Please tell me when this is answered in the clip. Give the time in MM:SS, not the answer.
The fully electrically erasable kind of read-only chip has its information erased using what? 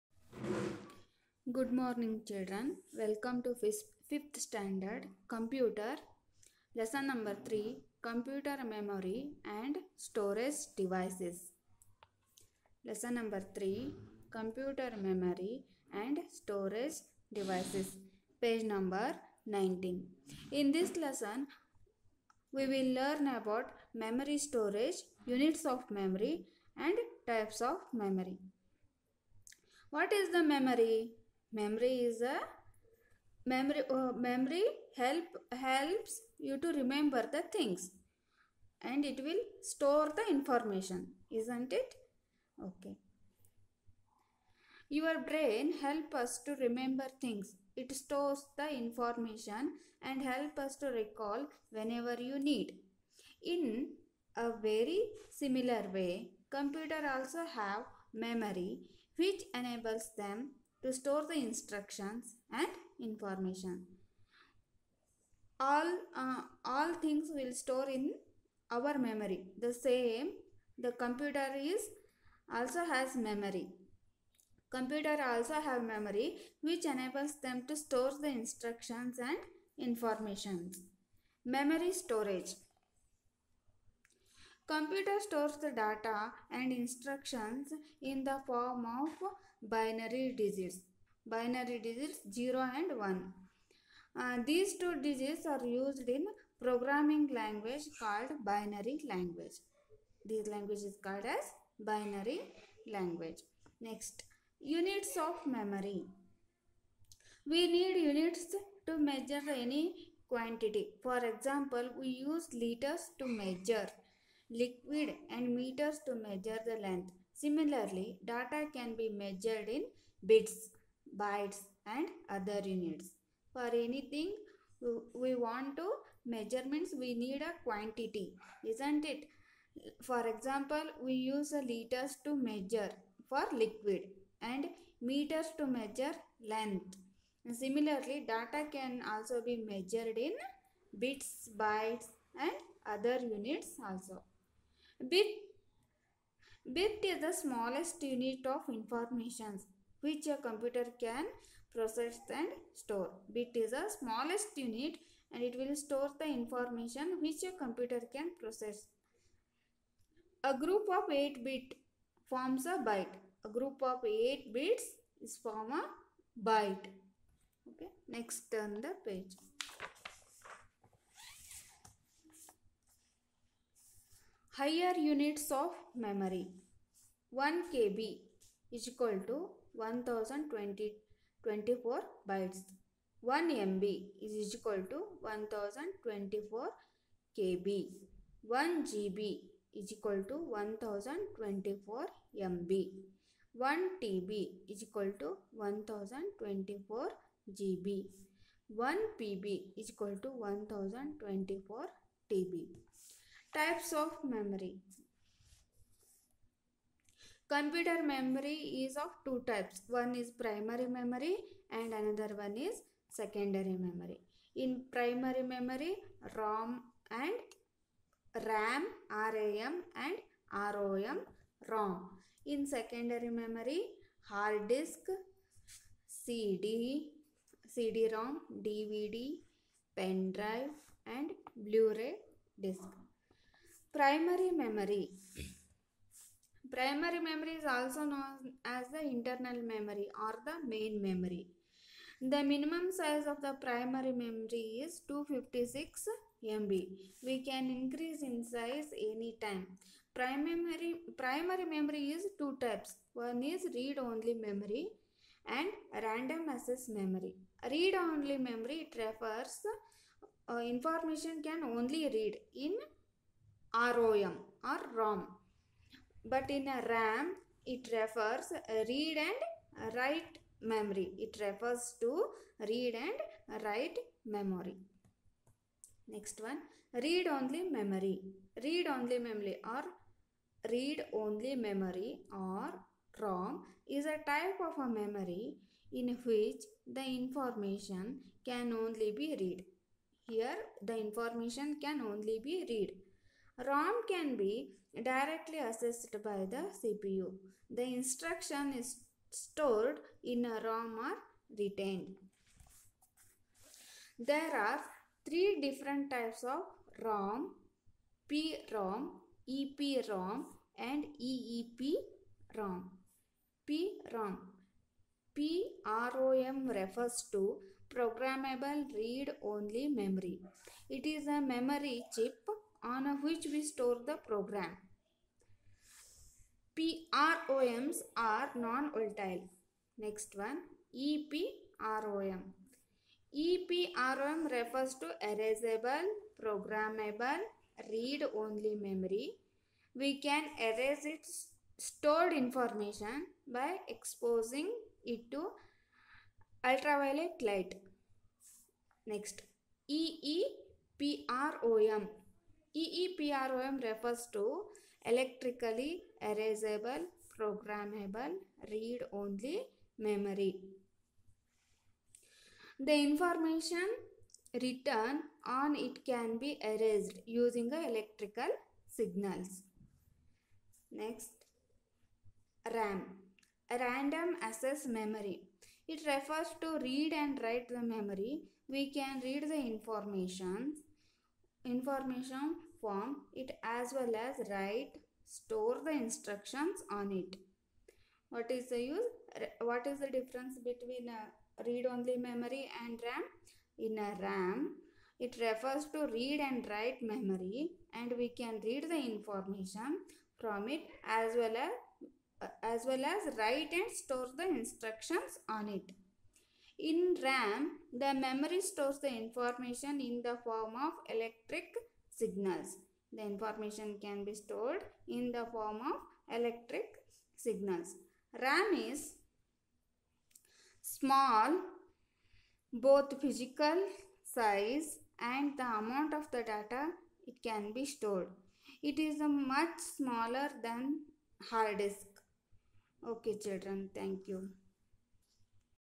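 06:07.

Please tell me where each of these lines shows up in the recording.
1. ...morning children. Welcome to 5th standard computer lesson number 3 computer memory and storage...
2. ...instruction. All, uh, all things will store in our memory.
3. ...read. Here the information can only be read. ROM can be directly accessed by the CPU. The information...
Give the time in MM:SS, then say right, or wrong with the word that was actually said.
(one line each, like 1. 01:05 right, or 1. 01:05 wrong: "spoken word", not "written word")
1. 00:01 right
2. 01:02 wrong: "information", not "instruction"
3. 04:49 wrong: "instruction", not "information".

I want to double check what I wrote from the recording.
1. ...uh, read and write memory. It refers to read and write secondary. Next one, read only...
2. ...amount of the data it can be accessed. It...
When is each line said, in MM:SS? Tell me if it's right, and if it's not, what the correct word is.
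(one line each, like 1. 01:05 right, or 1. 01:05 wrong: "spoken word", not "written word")
1. 04:28 wrong: "memory", not "secondary"
2. 07:05 wrong: "stored", not "accessed".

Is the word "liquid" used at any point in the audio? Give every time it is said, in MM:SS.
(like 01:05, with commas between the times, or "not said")
01:54, 02:13.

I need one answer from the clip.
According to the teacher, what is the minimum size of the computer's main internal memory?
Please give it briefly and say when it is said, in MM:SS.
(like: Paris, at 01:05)
256 MB, at 04:05.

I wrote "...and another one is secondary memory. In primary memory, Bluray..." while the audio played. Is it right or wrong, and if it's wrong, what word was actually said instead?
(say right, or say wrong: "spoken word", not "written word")
wrong: "ROM", not "Bluray".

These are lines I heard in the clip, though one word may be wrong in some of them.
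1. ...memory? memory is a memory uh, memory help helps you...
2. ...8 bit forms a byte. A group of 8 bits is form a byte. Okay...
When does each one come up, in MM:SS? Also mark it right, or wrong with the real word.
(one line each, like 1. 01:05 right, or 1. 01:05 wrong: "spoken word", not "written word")
1. 00:30 right
2. 02:41 right.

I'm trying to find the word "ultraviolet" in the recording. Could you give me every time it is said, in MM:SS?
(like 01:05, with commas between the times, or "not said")
05:46.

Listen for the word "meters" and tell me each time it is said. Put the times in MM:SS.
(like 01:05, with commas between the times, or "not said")
01:55, 02:15.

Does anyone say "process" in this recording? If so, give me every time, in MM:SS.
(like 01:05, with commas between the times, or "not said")
02:31, 02:38.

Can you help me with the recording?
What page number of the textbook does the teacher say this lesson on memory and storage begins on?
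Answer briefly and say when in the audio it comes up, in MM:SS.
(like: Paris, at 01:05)
19, at 00:18.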